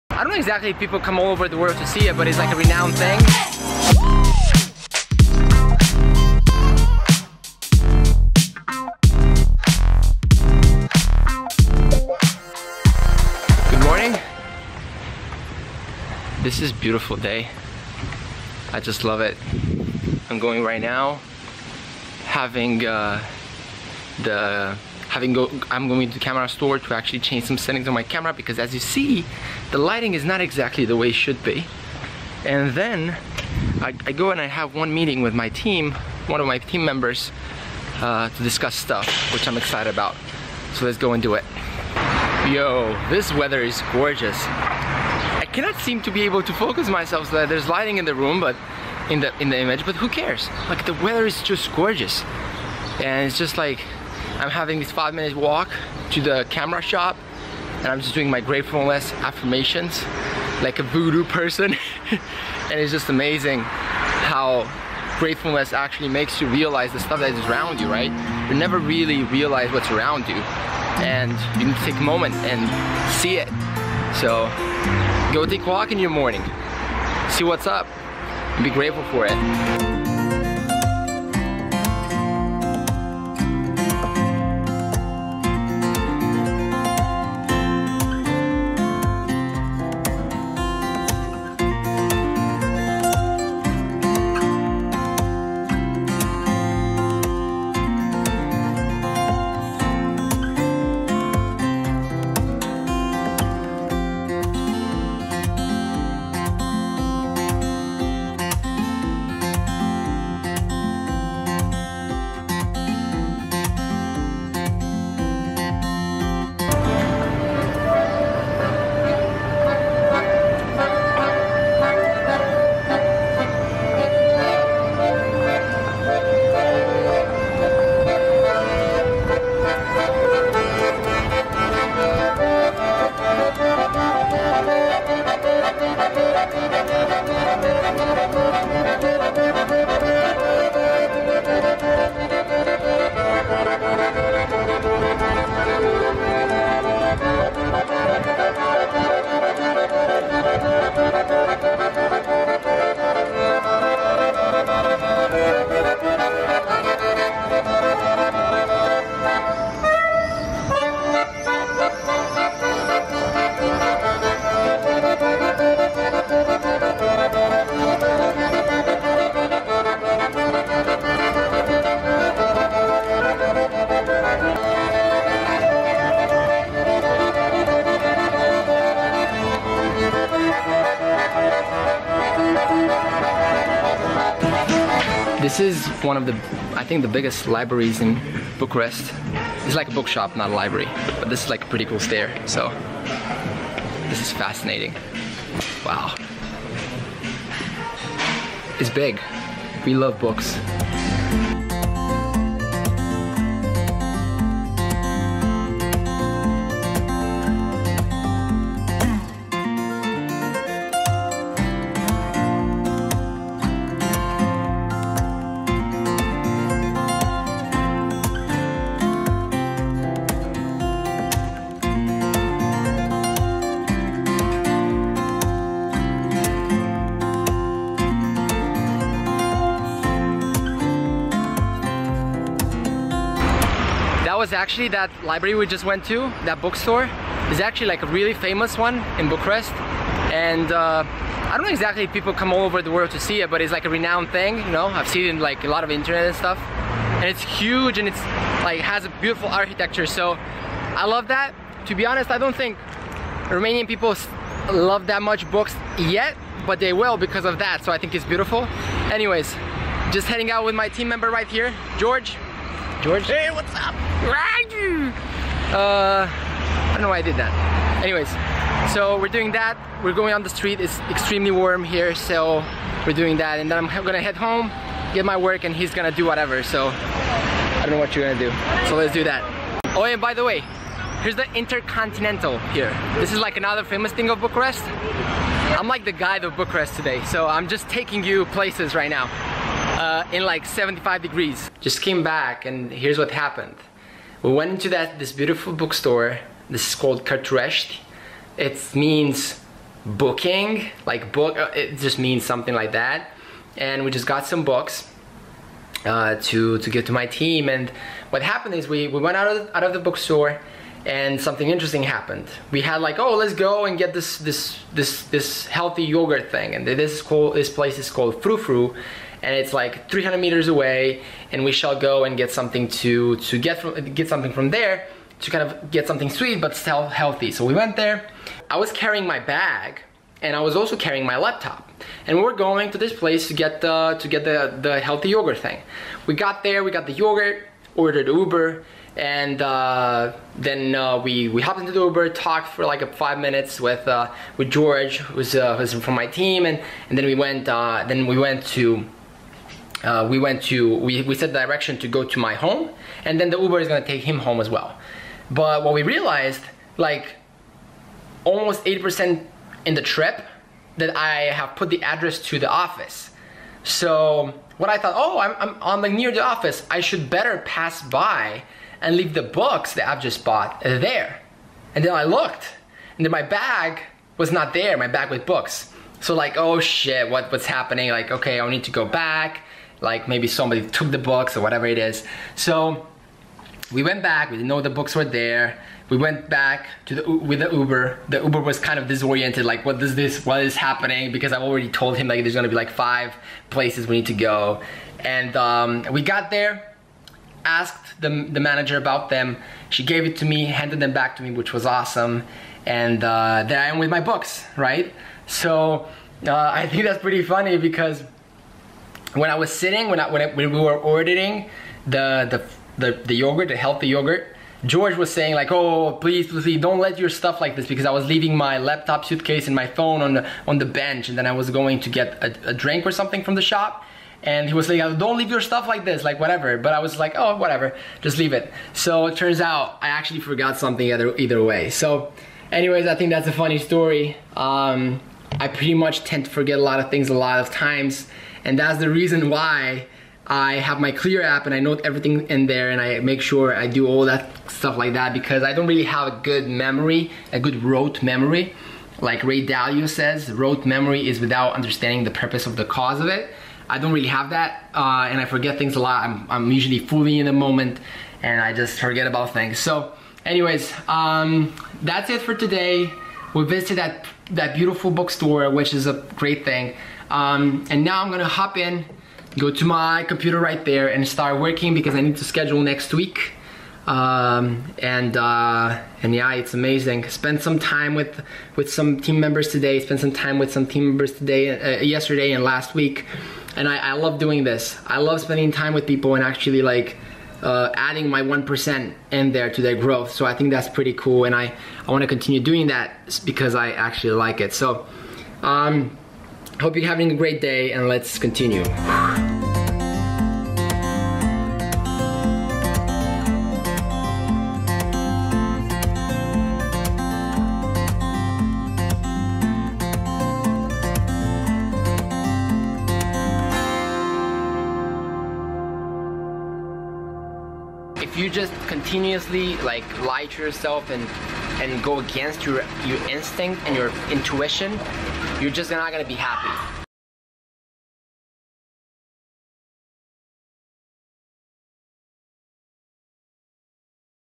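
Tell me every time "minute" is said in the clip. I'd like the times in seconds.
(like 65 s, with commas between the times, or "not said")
55 s, 343 s.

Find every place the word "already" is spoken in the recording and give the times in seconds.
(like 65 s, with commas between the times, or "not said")
391 s.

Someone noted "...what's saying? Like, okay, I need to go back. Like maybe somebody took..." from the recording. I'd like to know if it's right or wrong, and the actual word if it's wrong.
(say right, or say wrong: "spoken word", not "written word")
wrong: "happening", not "saying".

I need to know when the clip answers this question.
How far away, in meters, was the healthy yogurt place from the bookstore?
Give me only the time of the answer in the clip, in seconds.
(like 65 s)
320 s.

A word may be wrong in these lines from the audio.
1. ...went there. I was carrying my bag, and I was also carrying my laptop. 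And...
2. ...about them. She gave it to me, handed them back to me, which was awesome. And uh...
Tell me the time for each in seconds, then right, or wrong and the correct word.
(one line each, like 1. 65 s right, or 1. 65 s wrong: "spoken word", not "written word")
1. 327 s right
2. 398 s right.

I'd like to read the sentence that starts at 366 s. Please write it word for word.
I should better pass by and leave the books that I've just bought there.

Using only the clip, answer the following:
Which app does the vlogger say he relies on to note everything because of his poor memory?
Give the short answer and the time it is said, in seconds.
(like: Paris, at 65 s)
Clear, at 441 s.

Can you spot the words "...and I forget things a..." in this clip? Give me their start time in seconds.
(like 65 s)
455 s.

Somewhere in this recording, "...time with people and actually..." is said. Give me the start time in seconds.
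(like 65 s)
485 s.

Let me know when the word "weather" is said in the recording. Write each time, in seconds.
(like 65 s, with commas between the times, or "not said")
43 s, 50 s.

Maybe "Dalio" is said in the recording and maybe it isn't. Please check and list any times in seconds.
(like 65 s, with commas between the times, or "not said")
449 s.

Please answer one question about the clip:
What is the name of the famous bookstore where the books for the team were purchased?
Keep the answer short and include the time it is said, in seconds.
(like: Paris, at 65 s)
Cărturești, at 297 s.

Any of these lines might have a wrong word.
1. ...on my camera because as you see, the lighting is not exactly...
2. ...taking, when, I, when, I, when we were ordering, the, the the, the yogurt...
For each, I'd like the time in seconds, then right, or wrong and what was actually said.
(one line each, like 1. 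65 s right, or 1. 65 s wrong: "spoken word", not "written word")
1. 27 s right
2. 409 s wrong: "sitting", not "taking".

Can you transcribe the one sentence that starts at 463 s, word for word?
We visited that, that beautiful bookstore, which is a great thing.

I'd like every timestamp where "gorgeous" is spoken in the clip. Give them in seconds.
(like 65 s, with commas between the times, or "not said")
43 s, 51 s.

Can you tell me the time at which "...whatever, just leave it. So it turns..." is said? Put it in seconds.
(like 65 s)
427 s.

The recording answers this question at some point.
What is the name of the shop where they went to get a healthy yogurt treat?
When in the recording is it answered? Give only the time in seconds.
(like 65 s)
318 s.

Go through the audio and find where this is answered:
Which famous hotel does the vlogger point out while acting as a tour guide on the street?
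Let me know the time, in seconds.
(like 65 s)
281 s.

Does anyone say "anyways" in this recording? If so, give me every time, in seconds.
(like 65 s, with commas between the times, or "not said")
259 s, 268 s, 432 s, 460 s.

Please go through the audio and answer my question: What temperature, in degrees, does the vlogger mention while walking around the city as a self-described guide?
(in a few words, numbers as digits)
75.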